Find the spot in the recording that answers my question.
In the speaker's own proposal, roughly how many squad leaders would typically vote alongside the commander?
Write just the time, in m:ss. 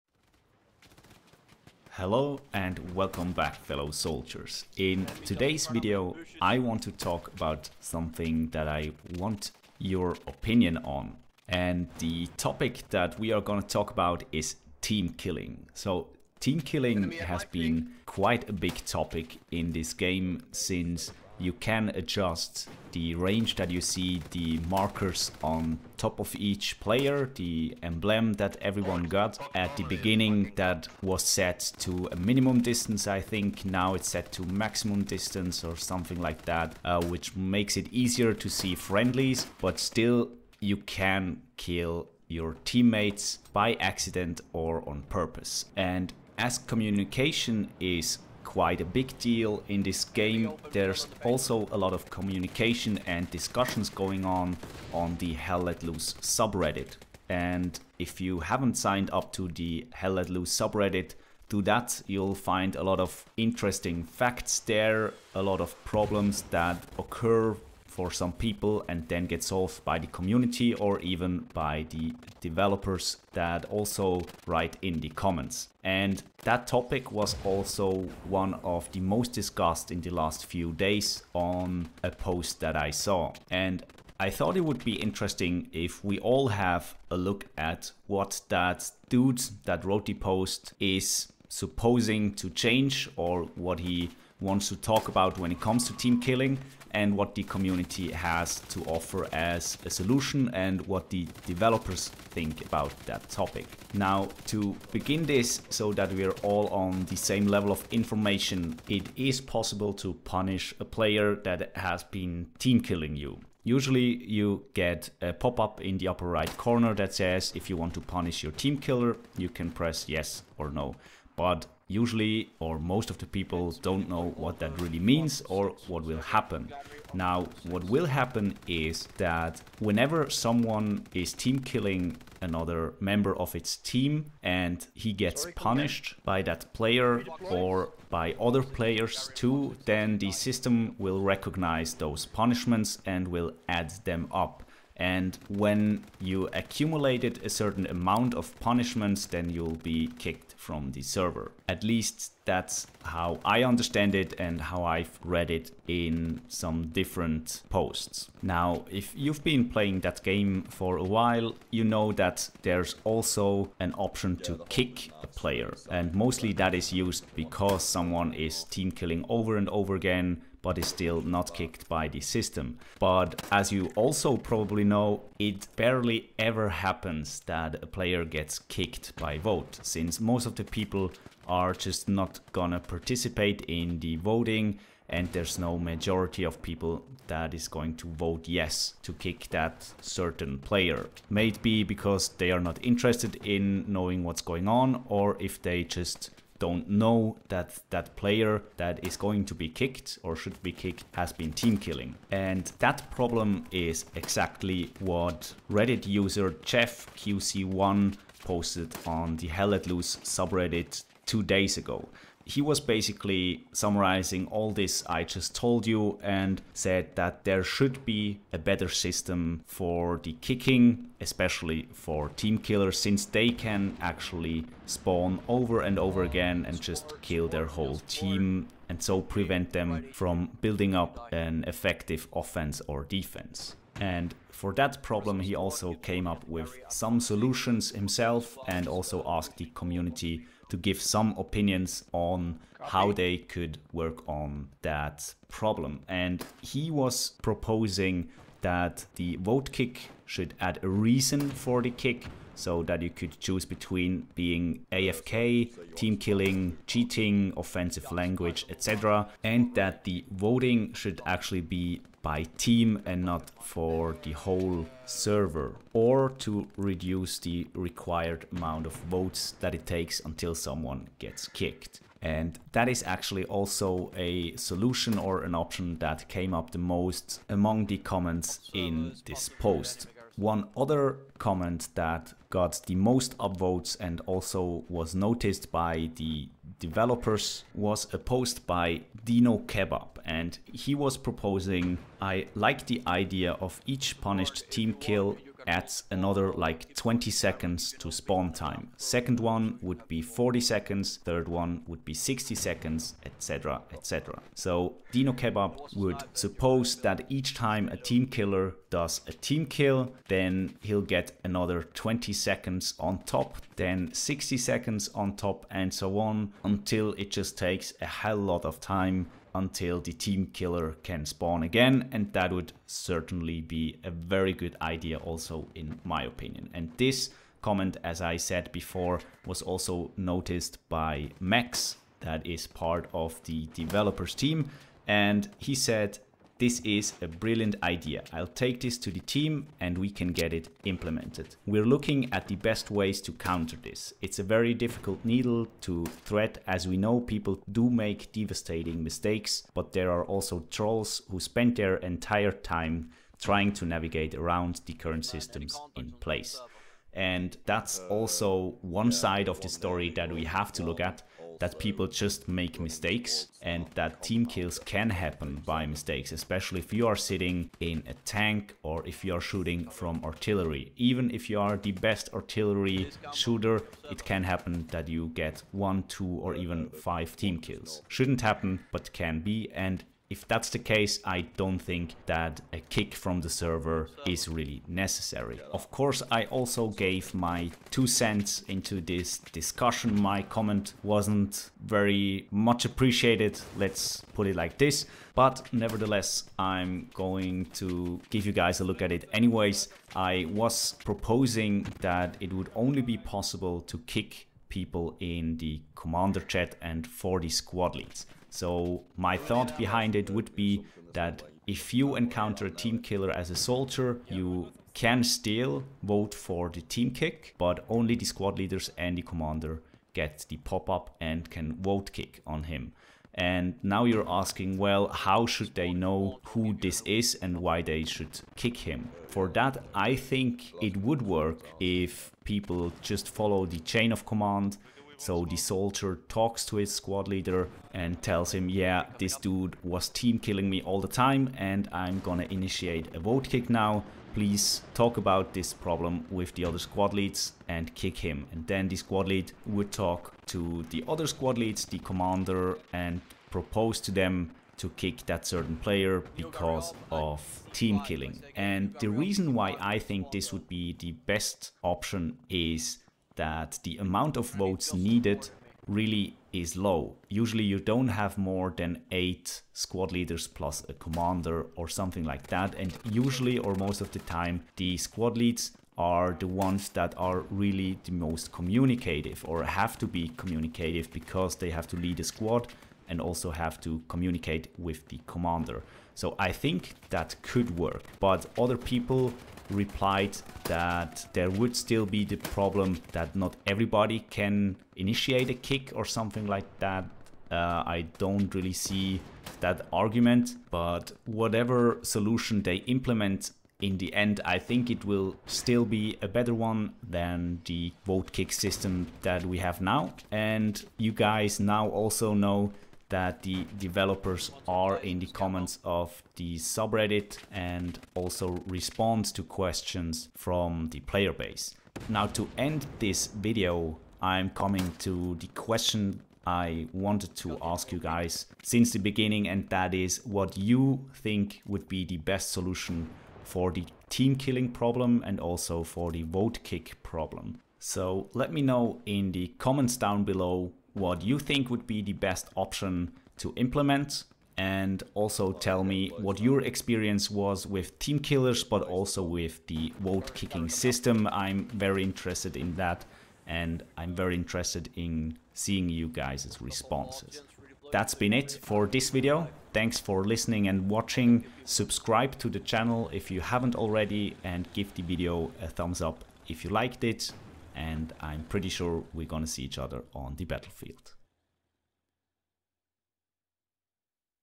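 7:49.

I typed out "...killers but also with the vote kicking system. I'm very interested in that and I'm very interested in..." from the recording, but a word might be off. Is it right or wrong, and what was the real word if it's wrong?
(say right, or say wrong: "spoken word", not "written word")
right.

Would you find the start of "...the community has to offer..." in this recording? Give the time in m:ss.
1:37.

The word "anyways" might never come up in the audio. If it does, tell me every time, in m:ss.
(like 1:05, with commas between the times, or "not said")
6:39.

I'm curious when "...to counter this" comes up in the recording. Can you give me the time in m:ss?
5:43.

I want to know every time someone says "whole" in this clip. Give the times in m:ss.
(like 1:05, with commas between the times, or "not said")
3:47, 4:24.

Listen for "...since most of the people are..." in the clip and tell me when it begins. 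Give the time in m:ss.
2:59.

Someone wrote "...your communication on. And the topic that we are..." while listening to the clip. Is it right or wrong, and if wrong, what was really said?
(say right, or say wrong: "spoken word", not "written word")
wrong: "opinion", not "communication".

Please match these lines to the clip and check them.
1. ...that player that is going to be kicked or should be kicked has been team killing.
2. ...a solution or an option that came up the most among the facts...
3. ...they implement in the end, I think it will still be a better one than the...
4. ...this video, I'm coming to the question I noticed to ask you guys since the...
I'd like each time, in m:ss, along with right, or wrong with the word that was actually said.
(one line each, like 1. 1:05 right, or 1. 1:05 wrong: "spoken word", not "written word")
1. 3:17 right
2. 4:34 wrong: "comments", not "facts"
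3. 8:22 right
4. 8:42 wrong: "wanted", not "noticed".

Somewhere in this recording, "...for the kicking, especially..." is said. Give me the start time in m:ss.
3:39.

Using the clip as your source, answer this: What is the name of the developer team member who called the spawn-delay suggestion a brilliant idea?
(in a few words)
Max.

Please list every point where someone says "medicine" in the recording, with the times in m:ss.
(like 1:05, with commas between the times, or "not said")
not said.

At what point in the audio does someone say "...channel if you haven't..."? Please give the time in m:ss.
9:22.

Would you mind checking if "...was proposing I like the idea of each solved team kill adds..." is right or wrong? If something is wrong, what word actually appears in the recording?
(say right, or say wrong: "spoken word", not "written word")
wrong: "punished", not "solved".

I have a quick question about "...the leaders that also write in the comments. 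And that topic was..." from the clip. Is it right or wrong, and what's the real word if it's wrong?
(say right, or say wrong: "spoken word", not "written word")
wrong: "developers", not "leaders".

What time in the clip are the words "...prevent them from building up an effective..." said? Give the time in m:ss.
3:49.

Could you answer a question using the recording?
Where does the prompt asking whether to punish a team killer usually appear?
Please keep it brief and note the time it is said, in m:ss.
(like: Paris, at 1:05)
upper right corner, at 1:56.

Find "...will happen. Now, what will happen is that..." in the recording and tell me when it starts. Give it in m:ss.
2:06.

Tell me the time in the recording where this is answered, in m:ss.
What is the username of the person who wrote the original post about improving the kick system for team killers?
3:26.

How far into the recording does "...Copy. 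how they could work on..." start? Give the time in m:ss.
4:02.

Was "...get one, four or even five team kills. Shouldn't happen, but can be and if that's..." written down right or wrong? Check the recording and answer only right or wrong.
wrong.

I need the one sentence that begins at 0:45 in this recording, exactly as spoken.
And as communication is quite a big deal.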